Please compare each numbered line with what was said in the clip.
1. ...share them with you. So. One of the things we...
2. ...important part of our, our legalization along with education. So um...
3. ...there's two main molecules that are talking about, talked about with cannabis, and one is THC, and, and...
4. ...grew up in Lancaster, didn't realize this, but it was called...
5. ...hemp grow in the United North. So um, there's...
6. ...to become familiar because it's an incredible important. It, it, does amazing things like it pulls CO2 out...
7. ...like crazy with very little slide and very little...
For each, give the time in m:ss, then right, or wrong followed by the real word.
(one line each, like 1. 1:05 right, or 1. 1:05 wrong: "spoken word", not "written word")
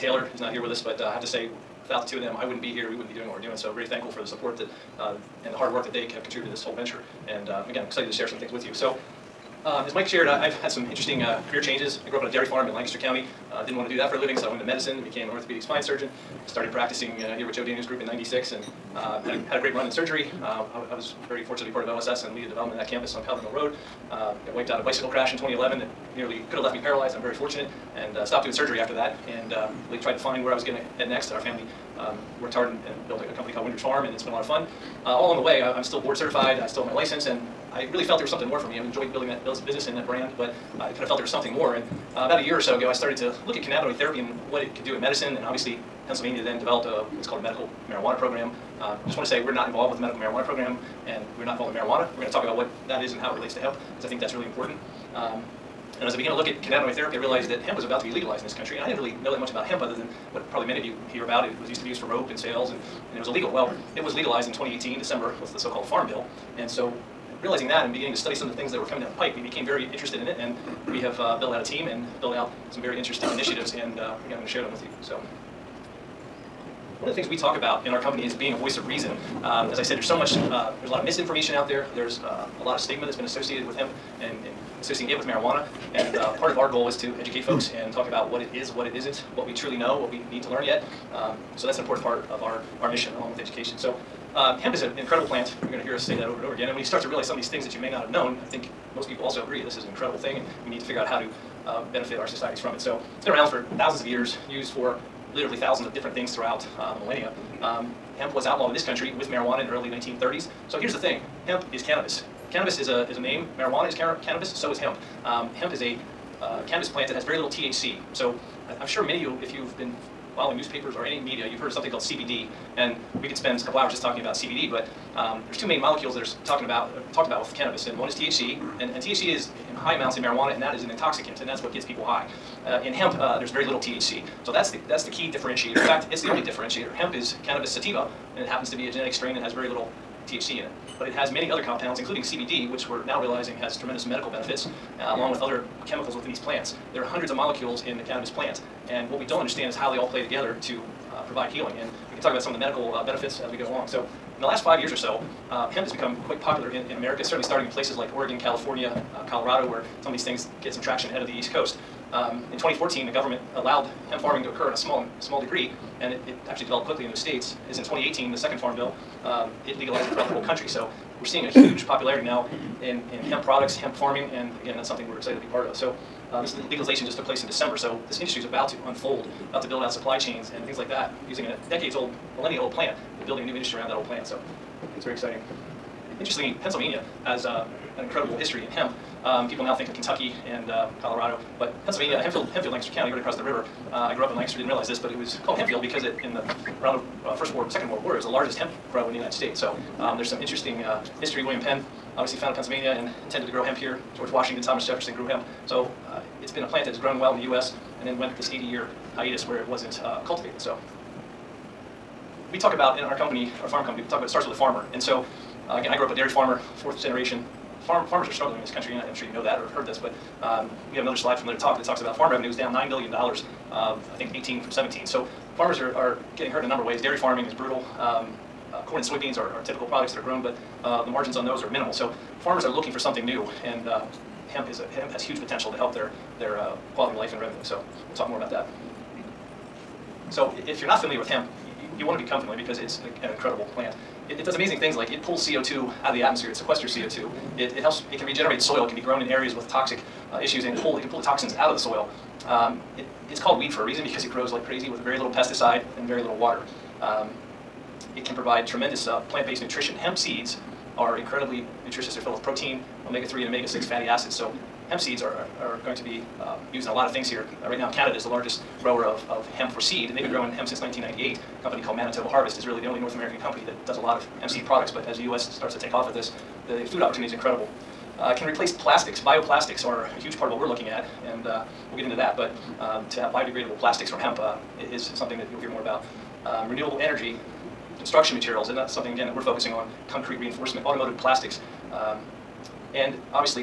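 1. 1:14 right
2. 1:31 wrong: "mission", not "legalization"
3. 2:05 right
4. 3:14 right
5. 3:18 wrong: "States", not "North"
6. 4:02 wrong: "plant", not "important"
7. 4:14 wrong: "pesticide", not "slide".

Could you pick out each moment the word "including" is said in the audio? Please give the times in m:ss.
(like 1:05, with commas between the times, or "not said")
2:21.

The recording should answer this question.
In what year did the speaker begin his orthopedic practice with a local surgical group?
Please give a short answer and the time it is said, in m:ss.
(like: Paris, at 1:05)
1996, at 0:18.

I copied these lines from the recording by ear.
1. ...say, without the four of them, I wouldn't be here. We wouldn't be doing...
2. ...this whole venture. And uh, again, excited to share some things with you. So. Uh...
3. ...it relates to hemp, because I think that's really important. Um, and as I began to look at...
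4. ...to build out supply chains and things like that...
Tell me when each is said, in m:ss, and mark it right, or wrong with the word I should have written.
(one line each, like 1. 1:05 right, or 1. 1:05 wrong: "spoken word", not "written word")
1. 0:01 wrong: "two", not "four"
2. 0:06 right
3. 0:53 right
4. 2:59 right.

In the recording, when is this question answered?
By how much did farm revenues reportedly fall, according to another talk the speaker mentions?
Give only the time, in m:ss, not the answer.
3:42.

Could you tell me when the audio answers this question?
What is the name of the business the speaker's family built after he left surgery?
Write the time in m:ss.
0:33.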